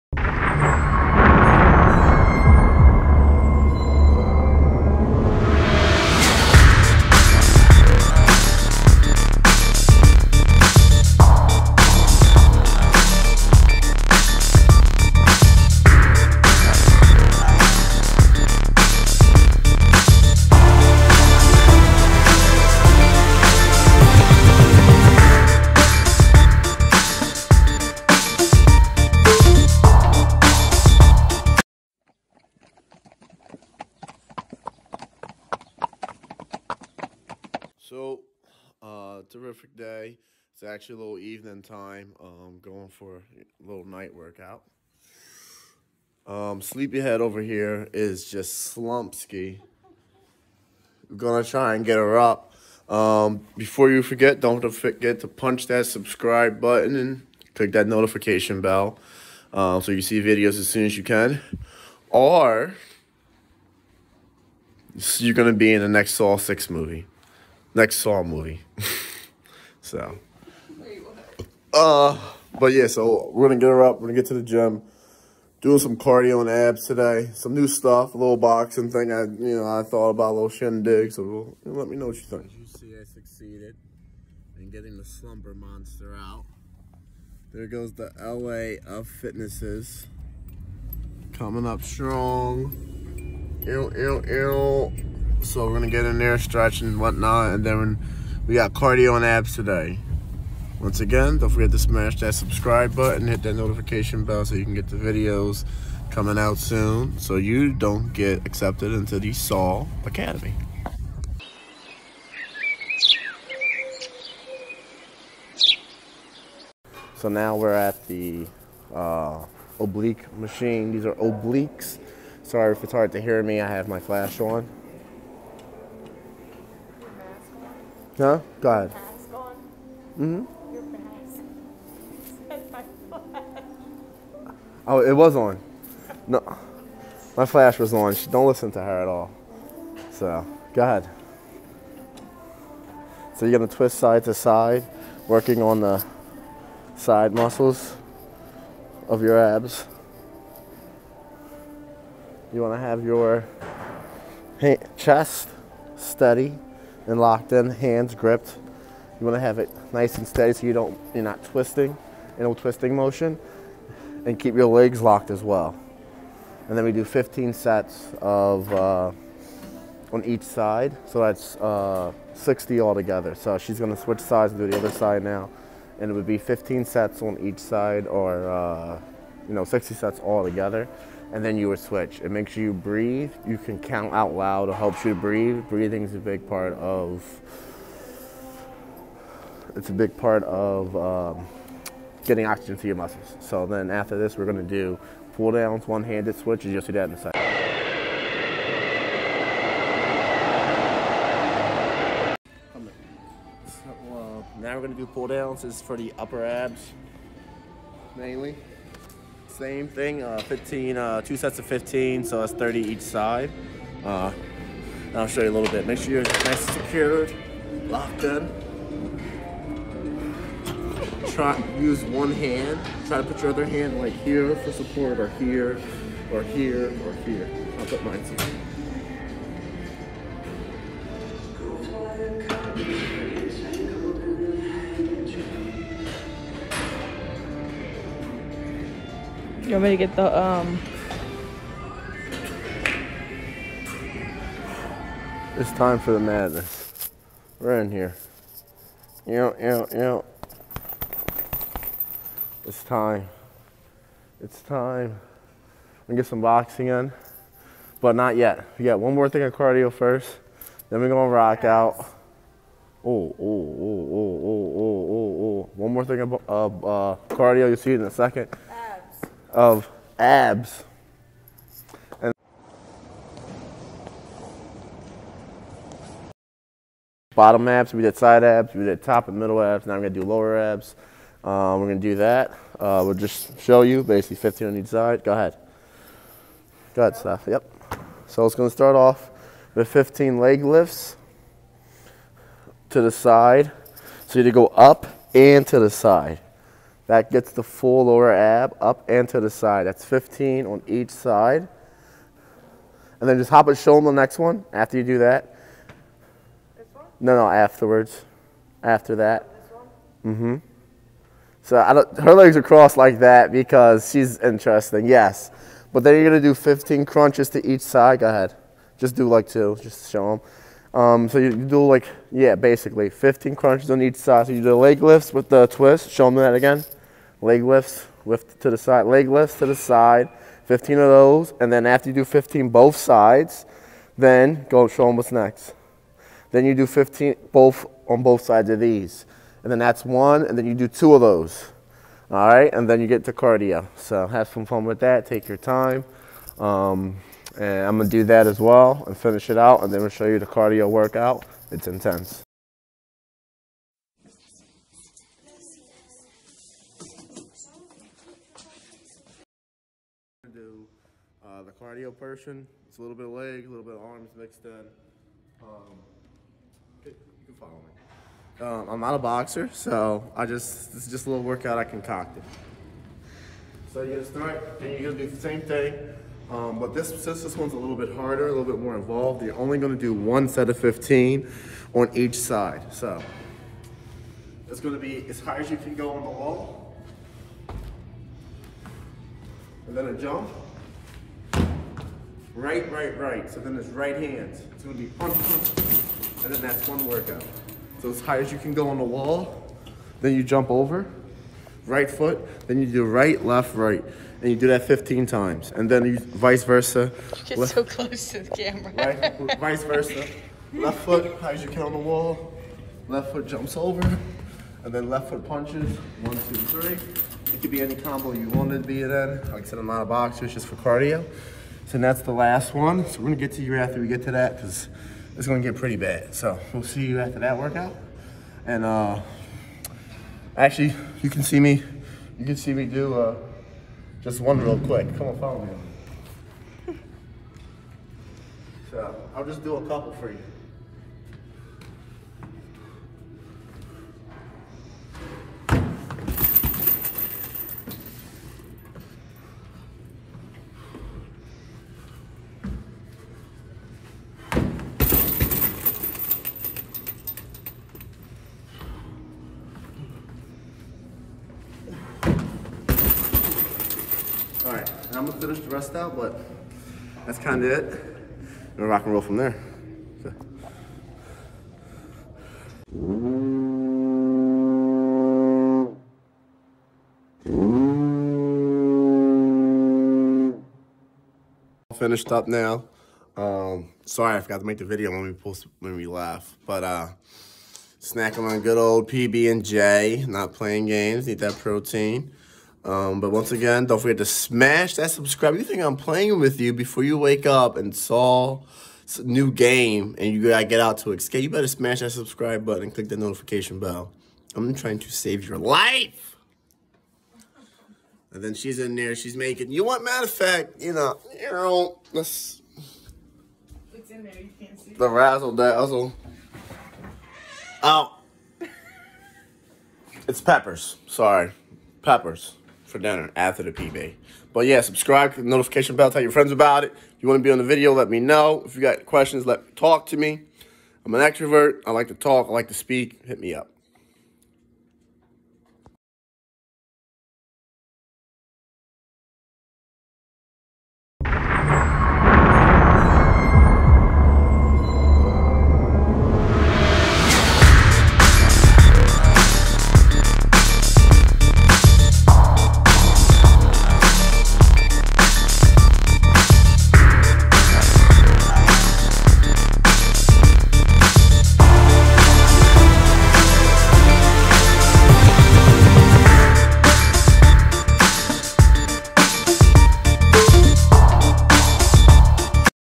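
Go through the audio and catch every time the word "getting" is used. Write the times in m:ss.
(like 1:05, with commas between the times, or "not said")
1:24, 3:12.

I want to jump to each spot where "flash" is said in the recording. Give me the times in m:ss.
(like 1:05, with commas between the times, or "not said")
2:03, 2:17.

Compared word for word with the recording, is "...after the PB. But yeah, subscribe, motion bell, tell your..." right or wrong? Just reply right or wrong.
wrong.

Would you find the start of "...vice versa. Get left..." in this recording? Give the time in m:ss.
6:46.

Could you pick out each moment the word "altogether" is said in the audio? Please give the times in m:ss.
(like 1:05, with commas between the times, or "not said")
2:52.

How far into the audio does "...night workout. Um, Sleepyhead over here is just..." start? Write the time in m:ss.
0:43.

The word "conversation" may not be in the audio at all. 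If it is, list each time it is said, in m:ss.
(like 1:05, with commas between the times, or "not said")
not said.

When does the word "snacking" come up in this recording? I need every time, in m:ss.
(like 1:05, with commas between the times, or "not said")
8:07.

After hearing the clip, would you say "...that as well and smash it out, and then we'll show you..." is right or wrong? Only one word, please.
wrong.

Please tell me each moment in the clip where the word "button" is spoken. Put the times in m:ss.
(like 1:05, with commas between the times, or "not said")
0:56, 1:42, 8:22.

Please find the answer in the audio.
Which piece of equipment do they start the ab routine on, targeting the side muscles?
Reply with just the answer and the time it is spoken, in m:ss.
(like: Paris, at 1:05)
oblique machine, at 1:59.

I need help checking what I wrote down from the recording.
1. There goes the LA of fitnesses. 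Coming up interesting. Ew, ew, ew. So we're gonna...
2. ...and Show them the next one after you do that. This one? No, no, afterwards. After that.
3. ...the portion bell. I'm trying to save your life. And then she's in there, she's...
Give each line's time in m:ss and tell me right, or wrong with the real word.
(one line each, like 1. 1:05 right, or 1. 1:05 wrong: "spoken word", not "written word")
1. 1:27 wrong: "strong", not "interesting"
2. 5:03 right
3. 8:23 wrong: "notification", not "portion".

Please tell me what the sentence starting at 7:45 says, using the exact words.
I'm gonna finish the rest out, but that's kind of it.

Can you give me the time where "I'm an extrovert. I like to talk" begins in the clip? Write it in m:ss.
8:51.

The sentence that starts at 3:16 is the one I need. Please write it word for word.
You'll see that in a second.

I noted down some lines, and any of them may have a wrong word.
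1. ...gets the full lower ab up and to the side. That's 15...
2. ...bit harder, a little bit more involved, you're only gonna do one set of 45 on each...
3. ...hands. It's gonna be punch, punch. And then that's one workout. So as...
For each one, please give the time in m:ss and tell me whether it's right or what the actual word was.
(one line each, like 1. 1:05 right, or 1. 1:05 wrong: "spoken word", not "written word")
1. 4:57 right
2. 6:17 wrong: "15", not "45"
3. 6:34 right.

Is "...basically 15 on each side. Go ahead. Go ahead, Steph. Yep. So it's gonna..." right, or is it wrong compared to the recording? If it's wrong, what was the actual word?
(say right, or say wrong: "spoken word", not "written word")
right.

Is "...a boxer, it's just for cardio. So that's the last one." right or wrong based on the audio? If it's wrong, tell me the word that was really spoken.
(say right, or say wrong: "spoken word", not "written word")
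right.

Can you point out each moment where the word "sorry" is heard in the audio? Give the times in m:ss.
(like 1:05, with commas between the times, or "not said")
2:02, 8:04, 8:41.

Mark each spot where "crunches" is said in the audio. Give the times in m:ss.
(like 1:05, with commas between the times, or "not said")
5:17, 5:23.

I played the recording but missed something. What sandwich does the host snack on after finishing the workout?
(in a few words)
PB and J.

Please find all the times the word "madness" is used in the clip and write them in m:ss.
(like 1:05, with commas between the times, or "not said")
4:06.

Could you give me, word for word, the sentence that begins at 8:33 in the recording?
It's in there, you can't see.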